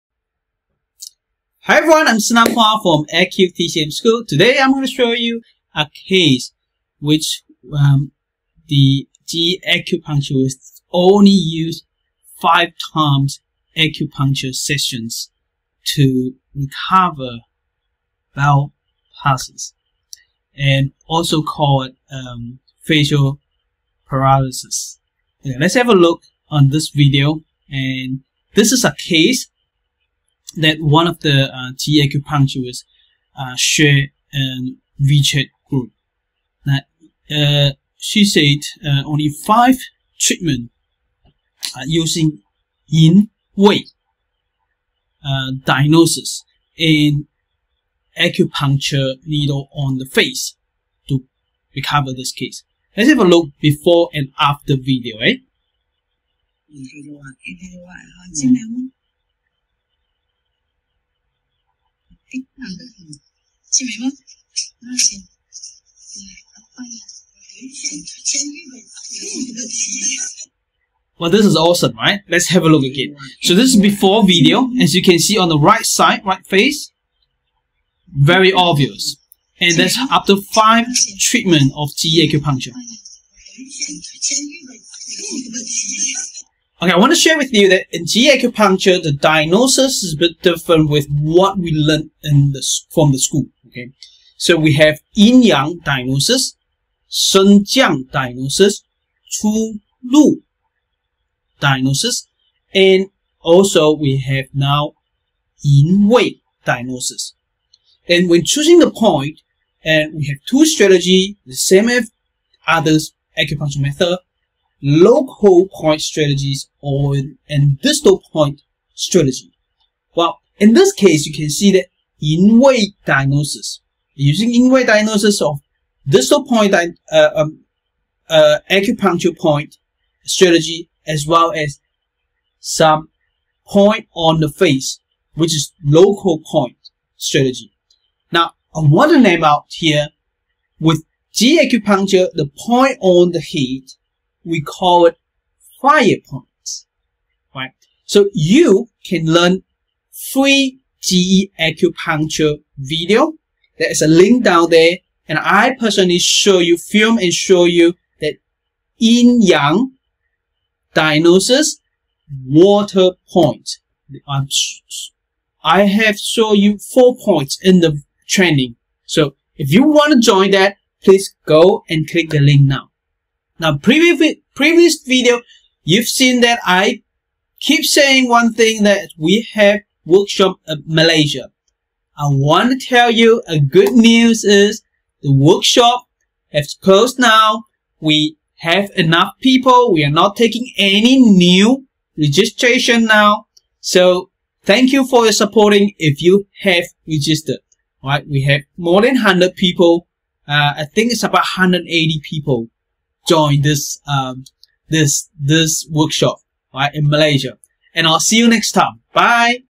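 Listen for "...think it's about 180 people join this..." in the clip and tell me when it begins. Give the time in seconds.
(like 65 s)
200 s.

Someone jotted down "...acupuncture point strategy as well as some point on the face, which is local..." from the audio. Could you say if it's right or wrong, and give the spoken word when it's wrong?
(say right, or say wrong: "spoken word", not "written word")
right.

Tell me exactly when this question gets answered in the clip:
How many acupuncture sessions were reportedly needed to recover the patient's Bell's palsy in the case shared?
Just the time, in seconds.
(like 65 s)
12 s.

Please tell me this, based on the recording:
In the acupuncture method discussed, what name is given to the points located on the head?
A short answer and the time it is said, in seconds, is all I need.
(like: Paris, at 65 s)
fire points, at 145 s.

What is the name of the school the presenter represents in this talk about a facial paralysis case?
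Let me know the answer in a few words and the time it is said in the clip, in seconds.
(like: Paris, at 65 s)
AcuTCM TCM School, at 3 s.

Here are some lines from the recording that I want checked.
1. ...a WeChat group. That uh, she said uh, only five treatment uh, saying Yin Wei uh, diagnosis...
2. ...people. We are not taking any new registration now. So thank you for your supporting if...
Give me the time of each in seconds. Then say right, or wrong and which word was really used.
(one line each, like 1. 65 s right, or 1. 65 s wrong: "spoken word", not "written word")
1. 34 s wrong: "using", not "saying"
2. 189 s right.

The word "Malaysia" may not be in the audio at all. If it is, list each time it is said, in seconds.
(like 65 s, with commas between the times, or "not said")
180 s, 207 s.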